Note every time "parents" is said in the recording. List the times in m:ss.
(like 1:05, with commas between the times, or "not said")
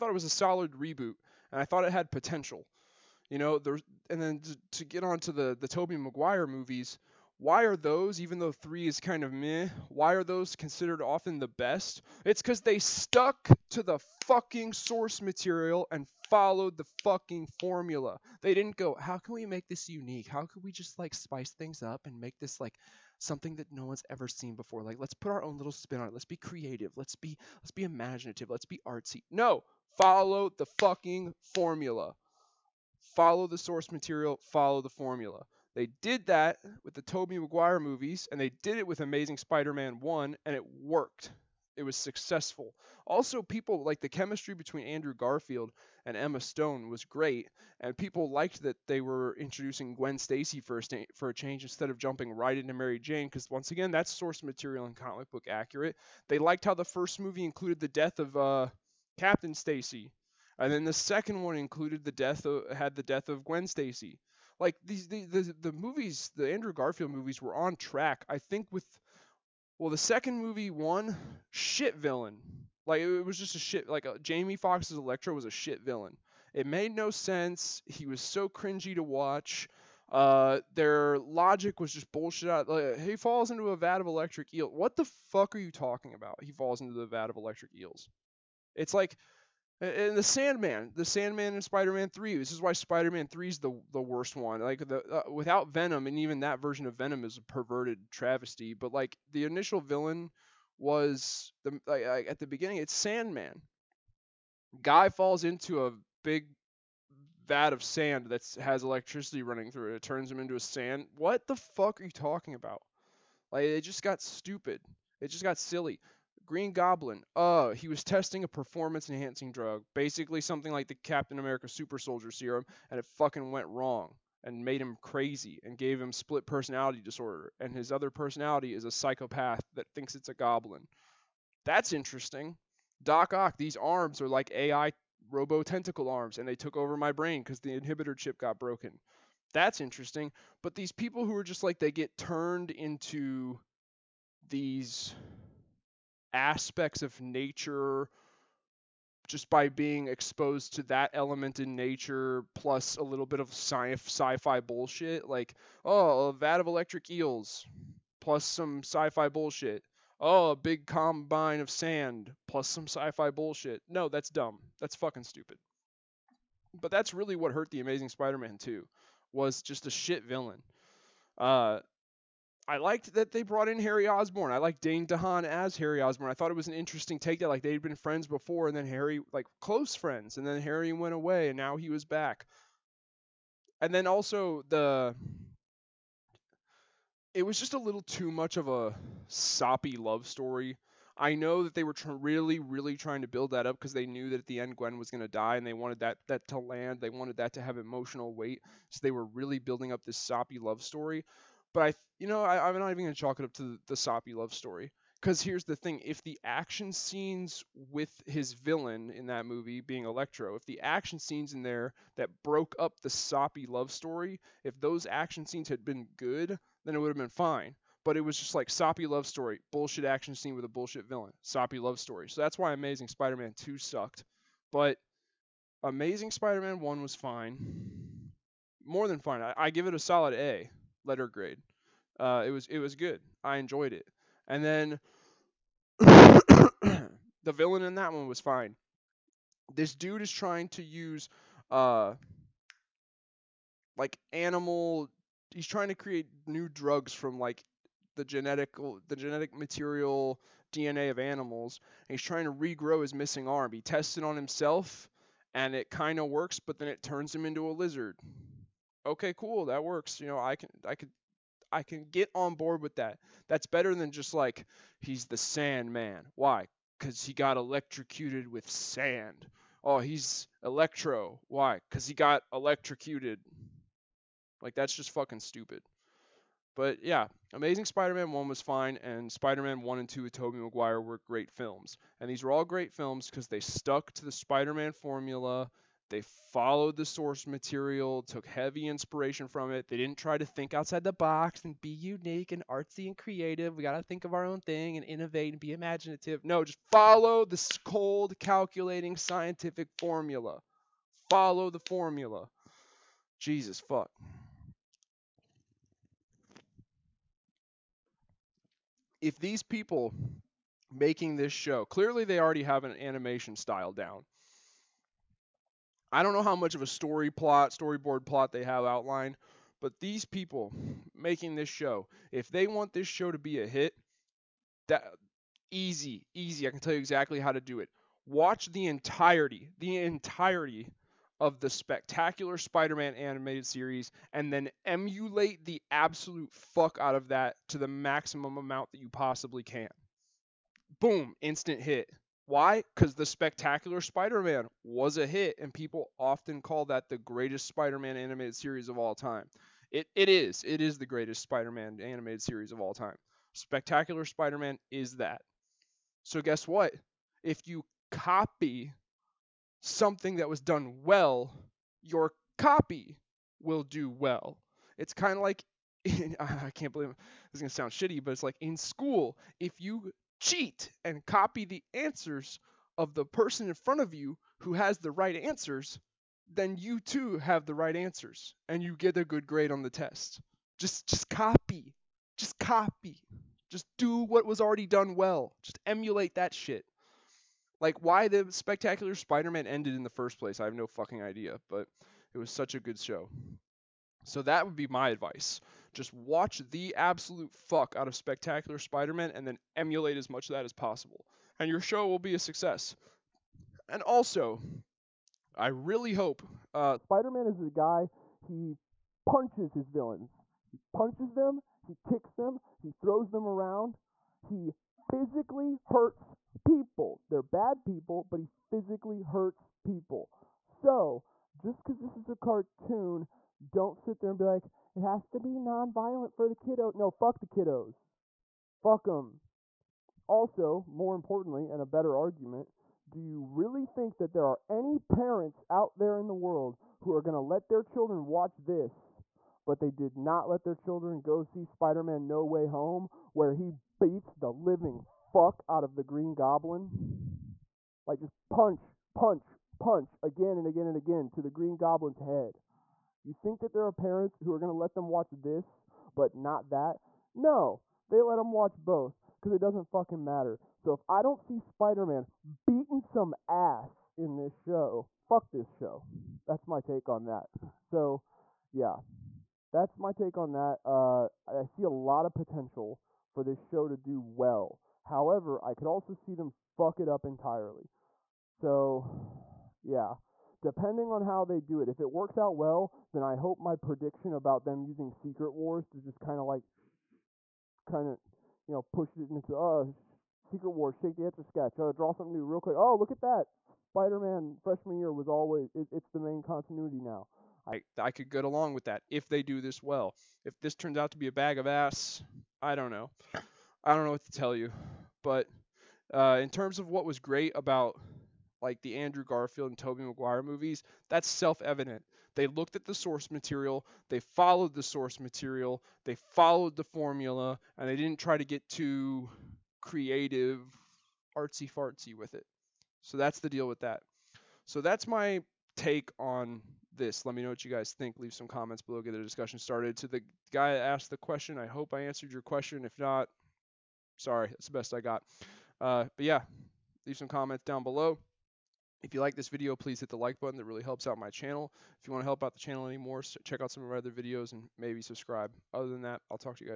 7:14, 7:33.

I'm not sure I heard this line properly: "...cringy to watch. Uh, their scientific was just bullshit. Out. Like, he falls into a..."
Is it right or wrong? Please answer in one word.
wrong.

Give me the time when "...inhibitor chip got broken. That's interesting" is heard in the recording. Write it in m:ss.
2:17.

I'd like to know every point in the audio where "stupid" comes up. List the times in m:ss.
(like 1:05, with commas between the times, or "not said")
1:54, 2:45, 4:35.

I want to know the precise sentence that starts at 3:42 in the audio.
So that's why Amazing Spider-Man 2 sucked.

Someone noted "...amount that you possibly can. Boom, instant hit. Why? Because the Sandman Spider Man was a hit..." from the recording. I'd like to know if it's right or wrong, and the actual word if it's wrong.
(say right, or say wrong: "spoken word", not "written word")
wrong: "Spectacular", not "Sandman".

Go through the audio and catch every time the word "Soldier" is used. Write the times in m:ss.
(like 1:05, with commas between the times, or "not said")
2:01.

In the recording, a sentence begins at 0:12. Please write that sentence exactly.
It's because they stuck to the fucking source material and followed the fucking formula.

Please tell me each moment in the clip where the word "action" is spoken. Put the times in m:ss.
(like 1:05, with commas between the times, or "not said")
3:26, 3:30, 3:35, 3:40.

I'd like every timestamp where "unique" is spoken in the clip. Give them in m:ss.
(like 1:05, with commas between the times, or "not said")
0:19, 4:51.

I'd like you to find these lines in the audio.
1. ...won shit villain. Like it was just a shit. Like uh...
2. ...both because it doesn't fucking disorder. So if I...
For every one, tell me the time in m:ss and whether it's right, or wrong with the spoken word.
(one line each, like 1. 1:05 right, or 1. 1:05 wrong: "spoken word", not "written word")
1. 1:10 right
2. 7:38 wrong: "matter", not "disorder".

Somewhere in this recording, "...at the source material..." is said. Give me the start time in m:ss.
8:32.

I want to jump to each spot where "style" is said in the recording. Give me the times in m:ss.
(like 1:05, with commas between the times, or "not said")
5:13.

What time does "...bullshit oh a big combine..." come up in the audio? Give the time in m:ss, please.
2:39.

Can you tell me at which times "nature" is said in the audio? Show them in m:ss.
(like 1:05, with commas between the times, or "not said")
2:27, 2:31.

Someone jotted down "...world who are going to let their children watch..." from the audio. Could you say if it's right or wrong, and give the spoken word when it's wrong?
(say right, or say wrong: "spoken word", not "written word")
right.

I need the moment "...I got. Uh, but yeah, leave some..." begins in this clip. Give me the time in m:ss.
8:54.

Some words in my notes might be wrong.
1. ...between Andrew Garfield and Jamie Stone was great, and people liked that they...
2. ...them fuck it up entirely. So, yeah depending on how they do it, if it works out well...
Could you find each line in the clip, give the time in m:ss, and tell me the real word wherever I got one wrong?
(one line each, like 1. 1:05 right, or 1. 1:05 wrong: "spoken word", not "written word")
1. 0:44 wrong: "Emma", not "Jamie"
2. 7:56 right.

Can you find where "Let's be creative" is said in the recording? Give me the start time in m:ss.
0:26.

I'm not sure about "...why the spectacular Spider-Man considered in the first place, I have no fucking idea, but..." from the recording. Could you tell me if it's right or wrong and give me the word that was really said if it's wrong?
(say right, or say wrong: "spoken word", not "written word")
wrong: "ended", not "considered".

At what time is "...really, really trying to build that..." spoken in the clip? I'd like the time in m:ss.
3:12.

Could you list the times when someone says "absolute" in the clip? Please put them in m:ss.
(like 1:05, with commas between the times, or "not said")
5:35, 6:36.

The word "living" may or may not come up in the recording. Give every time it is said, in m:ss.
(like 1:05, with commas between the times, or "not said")
7:24.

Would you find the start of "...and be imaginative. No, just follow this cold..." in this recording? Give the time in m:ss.
4:55.